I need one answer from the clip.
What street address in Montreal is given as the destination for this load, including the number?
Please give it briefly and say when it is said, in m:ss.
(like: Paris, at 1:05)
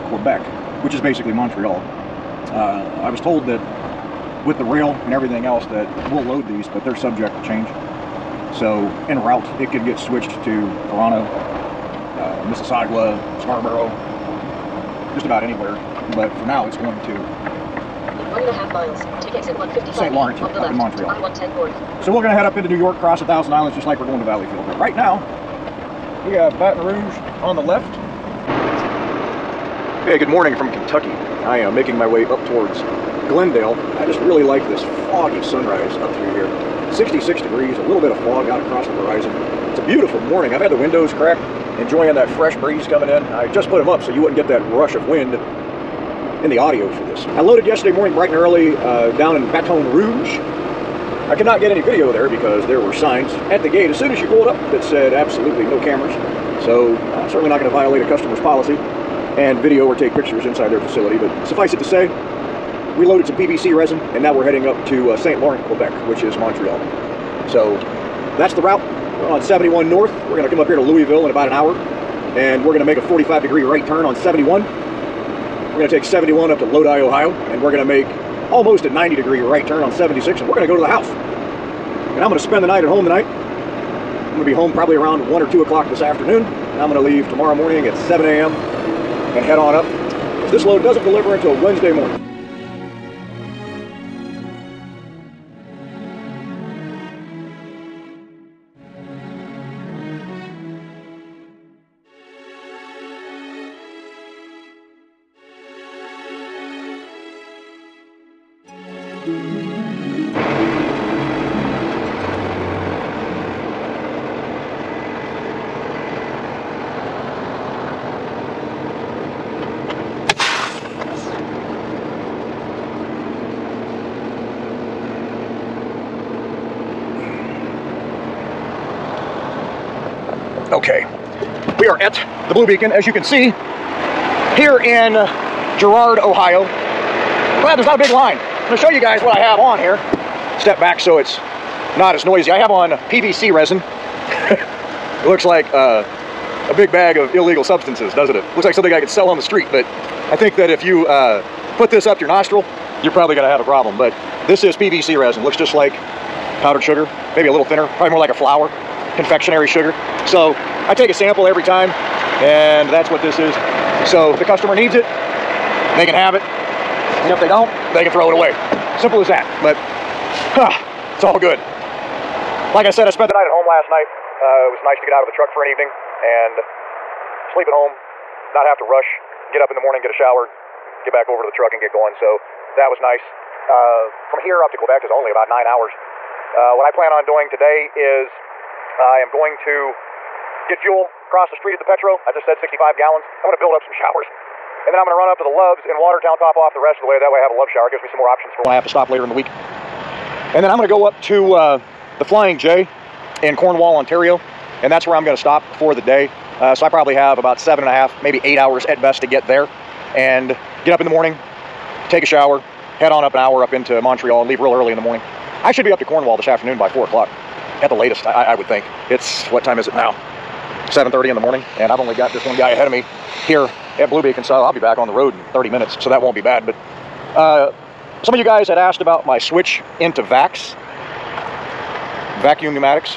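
155 St. Lawrence, at 0:19.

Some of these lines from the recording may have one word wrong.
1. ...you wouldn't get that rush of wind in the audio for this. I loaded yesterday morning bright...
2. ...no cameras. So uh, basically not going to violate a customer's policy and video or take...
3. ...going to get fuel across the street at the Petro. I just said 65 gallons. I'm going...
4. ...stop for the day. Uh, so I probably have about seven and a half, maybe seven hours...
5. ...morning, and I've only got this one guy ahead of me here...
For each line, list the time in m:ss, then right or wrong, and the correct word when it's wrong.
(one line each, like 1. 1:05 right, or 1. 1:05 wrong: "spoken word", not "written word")
1. 0:44 right
2. 0:55 wrong: "certainly", not "basically"
3. 3:09 right
4. 3:25 wrong: "eight", not "seven"
5. 3:41 right.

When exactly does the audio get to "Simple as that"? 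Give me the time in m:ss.
2:48.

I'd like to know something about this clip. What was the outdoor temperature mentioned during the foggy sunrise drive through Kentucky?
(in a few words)
66 degrees.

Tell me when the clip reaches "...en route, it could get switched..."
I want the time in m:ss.
0:09.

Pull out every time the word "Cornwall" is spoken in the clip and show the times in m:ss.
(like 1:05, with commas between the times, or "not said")
3:23, 3:36.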